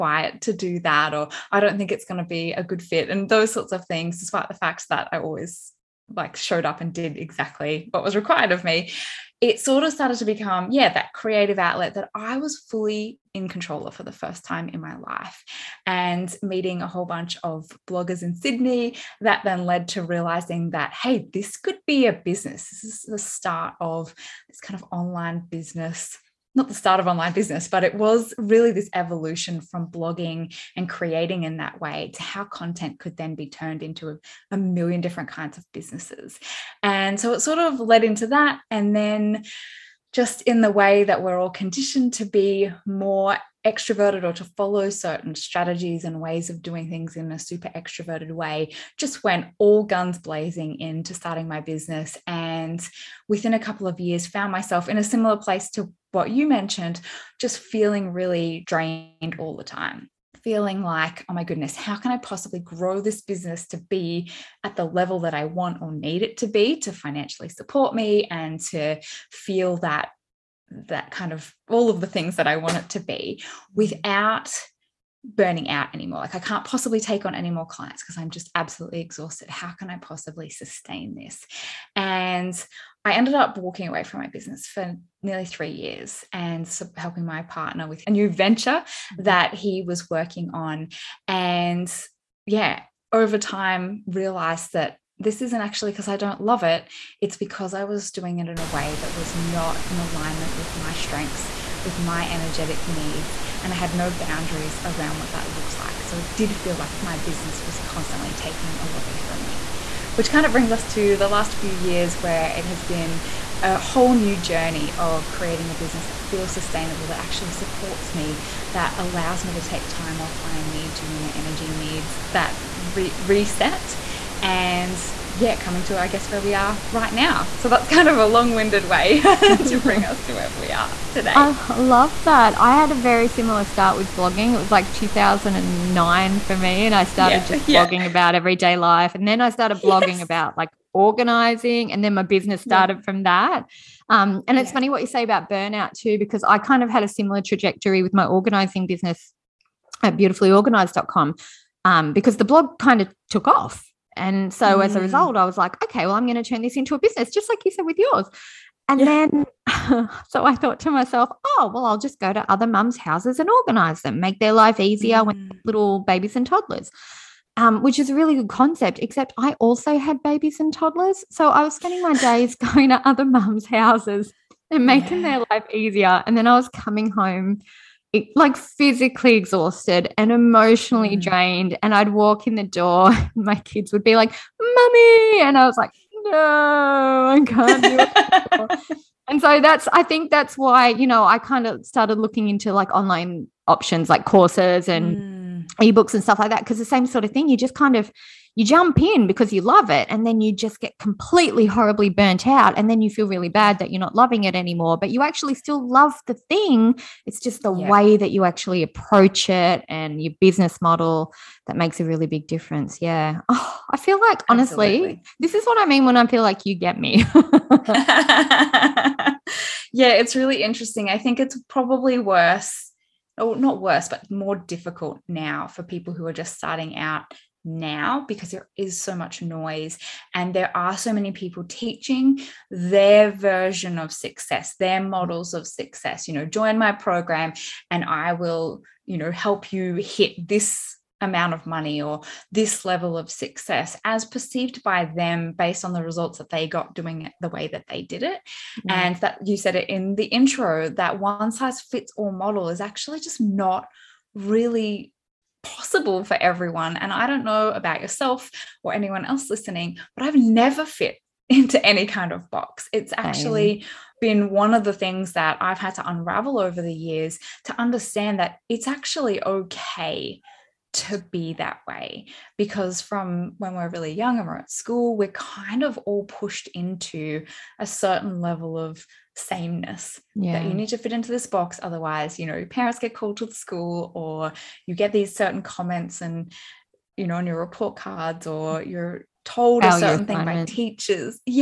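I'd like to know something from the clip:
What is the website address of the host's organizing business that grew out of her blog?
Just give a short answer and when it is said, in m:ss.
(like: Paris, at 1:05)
beautifullyorganized.com, at 2:30.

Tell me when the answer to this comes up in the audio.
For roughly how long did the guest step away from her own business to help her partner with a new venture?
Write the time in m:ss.
1:25.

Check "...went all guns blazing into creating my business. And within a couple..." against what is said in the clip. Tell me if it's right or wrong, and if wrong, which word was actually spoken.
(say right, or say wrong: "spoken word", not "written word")
wrong: "starting", not "creating".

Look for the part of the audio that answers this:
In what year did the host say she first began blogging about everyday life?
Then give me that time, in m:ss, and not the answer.
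2:14.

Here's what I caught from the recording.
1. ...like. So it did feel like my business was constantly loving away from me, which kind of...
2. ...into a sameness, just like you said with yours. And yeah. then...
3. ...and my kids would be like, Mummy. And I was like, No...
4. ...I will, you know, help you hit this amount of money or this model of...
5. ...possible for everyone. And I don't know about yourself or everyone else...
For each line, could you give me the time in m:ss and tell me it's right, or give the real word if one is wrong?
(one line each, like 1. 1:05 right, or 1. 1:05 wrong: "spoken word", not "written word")
1. 1:45 wrong: "taking", not "loving"
2. 2:36 wrong: "business", not "sameness"
3. 3:03 right
4. 3:58 wrong: "level", not "model"
5. 4:15 wrong: "anyone", not "everyone".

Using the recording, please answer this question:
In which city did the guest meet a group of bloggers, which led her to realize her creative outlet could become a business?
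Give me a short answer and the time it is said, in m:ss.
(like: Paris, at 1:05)
Sydney, at 0:18.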